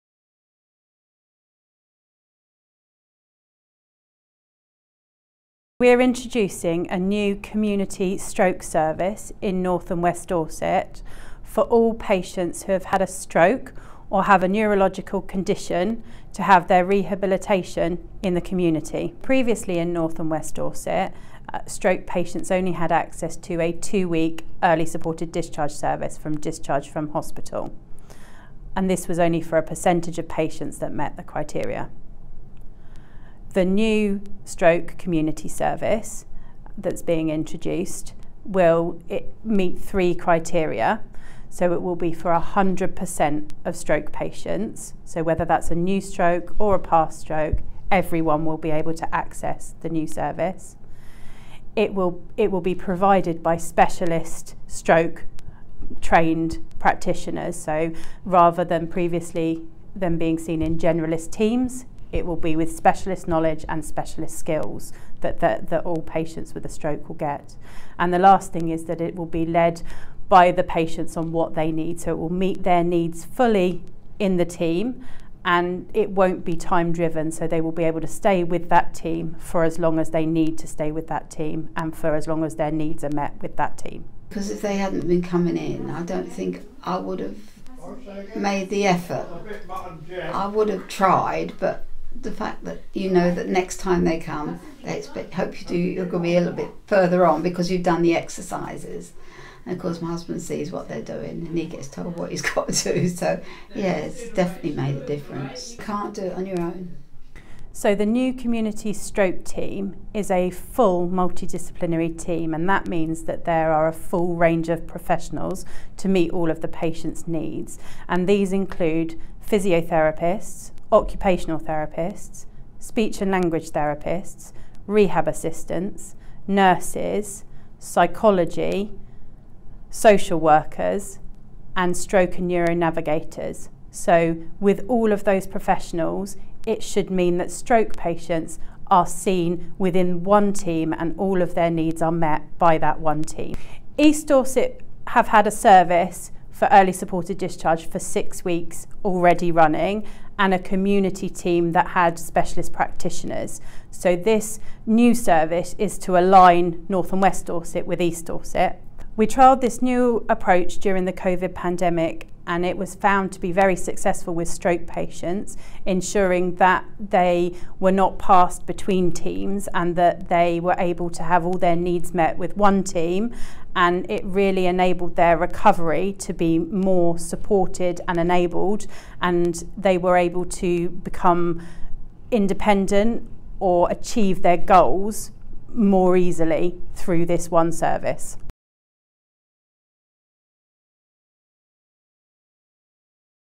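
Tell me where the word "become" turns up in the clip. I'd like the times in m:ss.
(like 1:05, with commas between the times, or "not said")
3:00.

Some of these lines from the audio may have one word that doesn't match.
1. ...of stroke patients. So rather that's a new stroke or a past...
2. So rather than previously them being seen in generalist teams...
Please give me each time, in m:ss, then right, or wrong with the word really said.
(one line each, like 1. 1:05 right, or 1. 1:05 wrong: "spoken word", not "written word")
1. 0:43 wrong: "whether", not "rather"
2. 0:57 right.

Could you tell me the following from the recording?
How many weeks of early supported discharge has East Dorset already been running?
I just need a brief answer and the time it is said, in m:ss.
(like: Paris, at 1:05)
6 weeks, at 2:27.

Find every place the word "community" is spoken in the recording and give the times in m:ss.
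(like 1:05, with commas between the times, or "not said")
0:07, 0:18, 0:34, 1:48, 2:30.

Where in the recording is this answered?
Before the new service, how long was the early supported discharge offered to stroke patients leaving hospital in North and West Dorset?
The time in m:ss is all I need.
0:23.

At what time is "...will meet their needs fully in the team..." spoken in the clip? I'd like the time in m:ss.
1:12.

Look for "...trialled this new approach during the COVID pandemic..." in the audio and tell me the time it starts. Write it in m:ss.
2:39.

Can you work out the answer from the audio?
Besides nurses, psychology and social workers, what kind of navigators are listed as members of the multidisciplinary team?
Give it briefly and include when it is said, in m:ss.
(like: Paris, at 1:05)
Stroke and neuronavigators, at 2:11.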